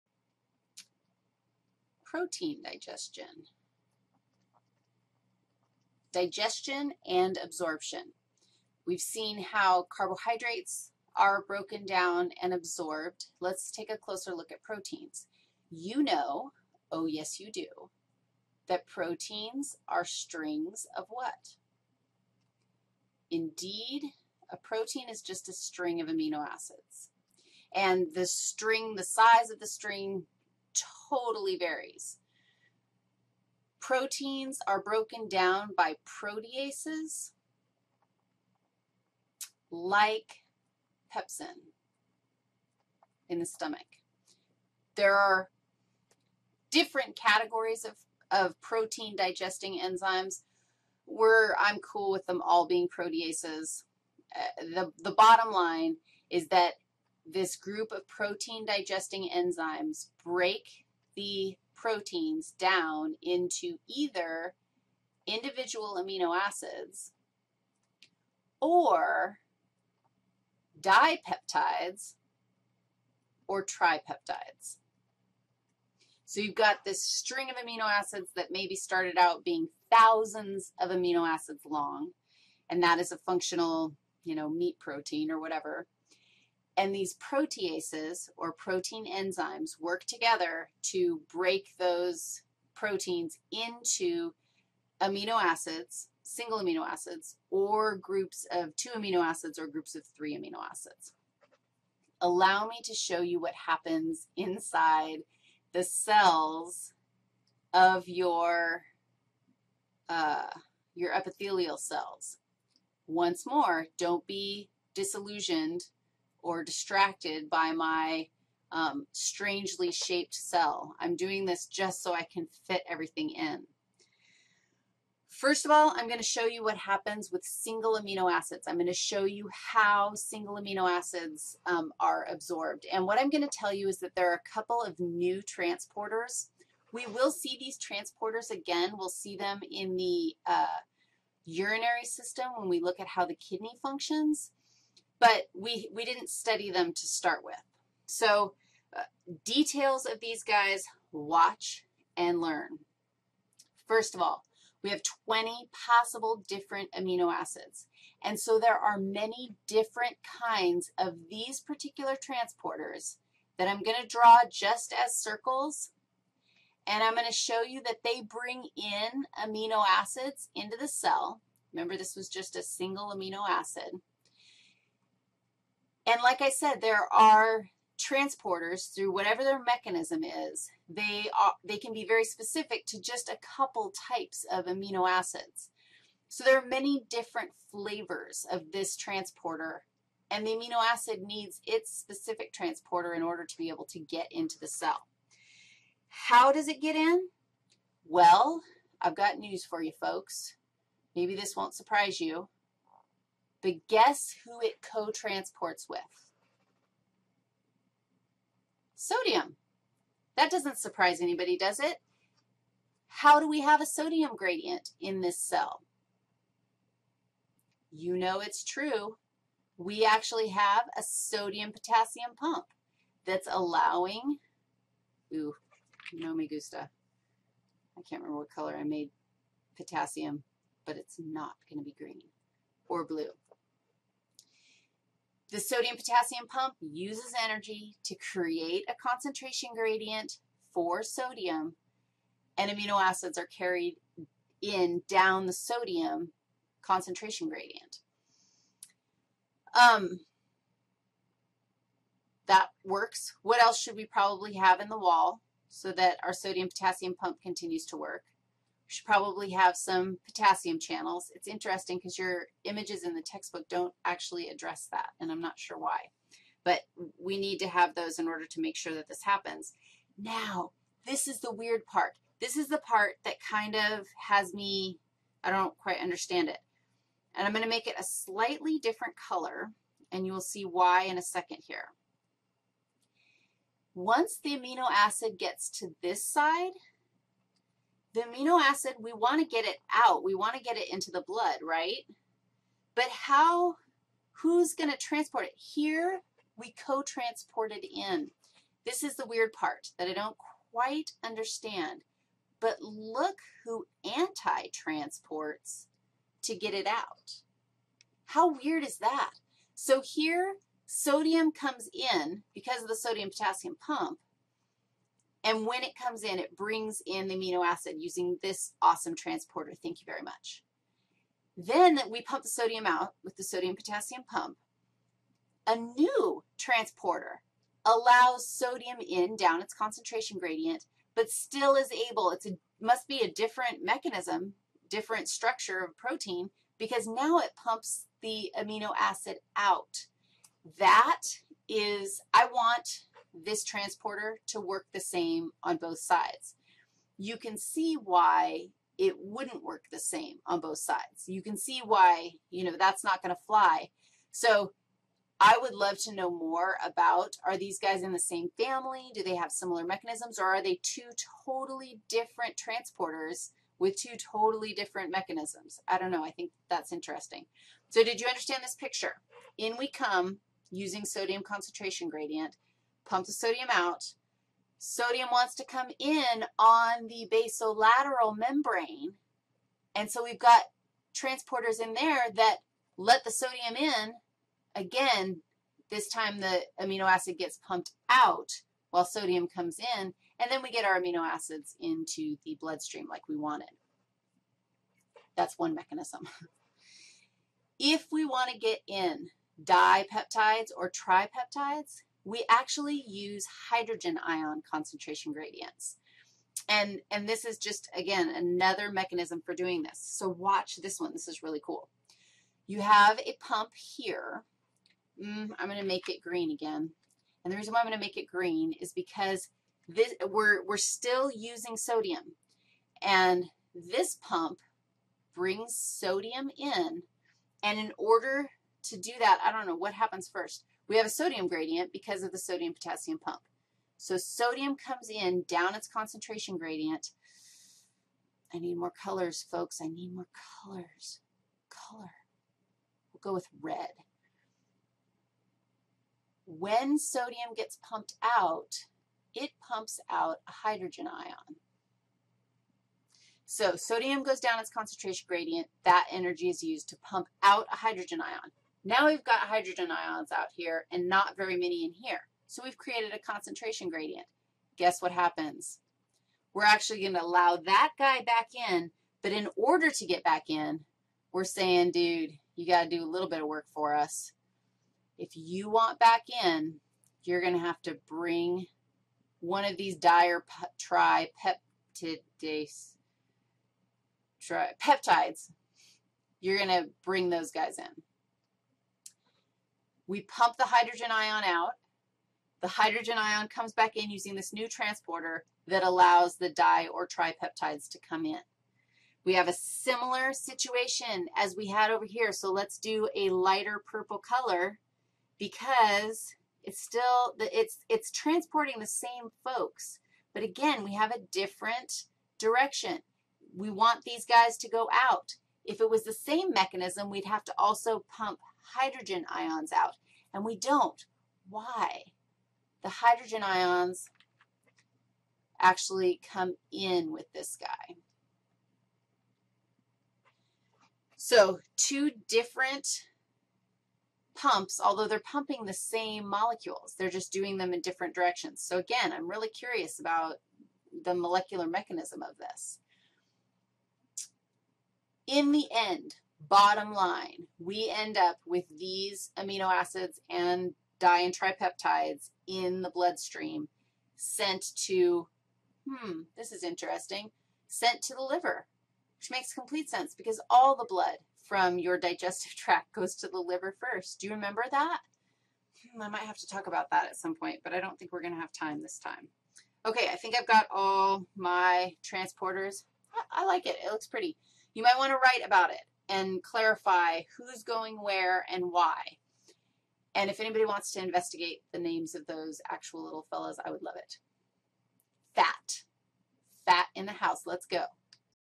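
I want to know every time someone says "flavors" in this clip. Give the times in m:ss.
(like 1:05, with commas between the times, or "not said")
3:07.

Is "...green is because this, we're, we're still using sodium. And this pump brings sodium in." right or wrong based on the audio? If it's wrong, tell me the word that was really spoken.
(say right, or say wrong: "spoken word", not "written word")
right.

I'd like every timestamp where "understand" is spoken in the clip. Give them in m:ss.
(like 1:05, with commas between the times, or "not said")
4:35, 5:01, 6:08.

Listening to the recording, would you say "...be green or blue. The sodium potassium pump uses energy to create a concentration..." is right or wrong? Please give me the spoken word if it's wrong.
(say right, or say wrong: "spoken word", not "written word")
right.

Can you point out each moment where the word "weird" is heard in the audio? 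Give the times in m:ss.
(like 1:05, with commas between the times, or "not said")
4:31, 4:59, 5:08.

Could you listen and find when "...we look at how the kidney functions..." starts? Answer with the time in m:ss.
2:22.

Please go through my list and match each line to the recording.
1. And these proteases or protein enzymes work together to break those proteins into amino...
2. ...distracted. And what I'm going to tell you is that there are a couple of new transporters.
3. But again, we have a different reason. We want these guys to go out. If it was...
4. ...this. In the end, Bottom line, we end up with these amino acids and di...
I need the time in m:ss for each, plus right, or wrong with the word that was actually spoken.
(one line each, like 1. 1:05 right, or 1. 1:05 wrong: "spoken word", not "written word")
1. 1:26 right
2. 2:12 wrong: "absorbed", not "distracted"
3. 8:30 wrong: "direction", not "reason"
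4. 9:02 right.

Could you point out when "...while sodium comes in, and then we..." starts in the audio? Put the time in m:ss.
6:28.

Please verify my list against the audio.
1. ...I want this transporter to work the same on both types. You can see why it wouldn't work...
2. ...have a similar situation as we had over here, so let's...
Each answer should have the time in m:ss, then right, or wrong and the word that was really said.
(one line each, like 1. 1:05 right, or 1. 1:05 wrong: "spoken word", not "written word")
1. 5:42 wrong: "sides", not "types"
2. 8:19 right.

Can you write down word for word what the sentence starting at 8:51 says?
So two different pumps, although they're pumping the same molecules.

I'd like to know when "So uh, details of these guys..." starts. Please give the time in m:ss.
2:28.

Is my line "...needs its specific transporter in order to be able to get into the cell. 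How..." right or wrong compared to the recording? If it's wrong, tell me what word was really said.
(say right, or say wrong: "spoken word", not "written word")
right.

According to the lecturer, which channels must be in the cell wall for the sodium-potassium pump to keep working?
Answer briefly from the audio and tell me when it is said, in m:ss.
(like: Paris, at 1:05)
Potassium channels, at 4:20.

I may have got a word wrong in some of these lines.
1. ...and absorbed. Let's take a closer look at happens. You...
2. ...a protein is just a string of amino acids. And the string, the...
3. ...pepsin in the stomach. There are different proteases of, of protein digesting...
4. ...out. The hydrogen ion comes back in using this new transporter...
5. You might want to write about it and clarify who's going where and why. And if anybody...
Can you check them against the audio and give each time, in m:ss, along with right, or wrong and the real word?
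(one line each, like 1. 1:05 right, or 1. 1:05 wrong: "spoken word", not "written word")
1. 0:12 wrong: "proteins", not "happens"
2. 0:24 right
3. 0:41 wrong: "categories", not "proteases"
4. 8:11 right
5. 9:34 right.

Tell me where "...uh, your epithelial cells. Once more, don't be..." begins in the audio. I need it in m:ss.
1:50.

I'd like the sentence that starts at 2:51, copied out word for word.
Remember, this was just a single amino acid.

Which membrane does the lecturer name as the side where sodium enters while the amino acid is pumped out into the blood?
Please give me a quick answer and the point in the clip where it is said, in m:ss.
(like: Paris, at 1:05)
Basolateral membrane, at 6:17.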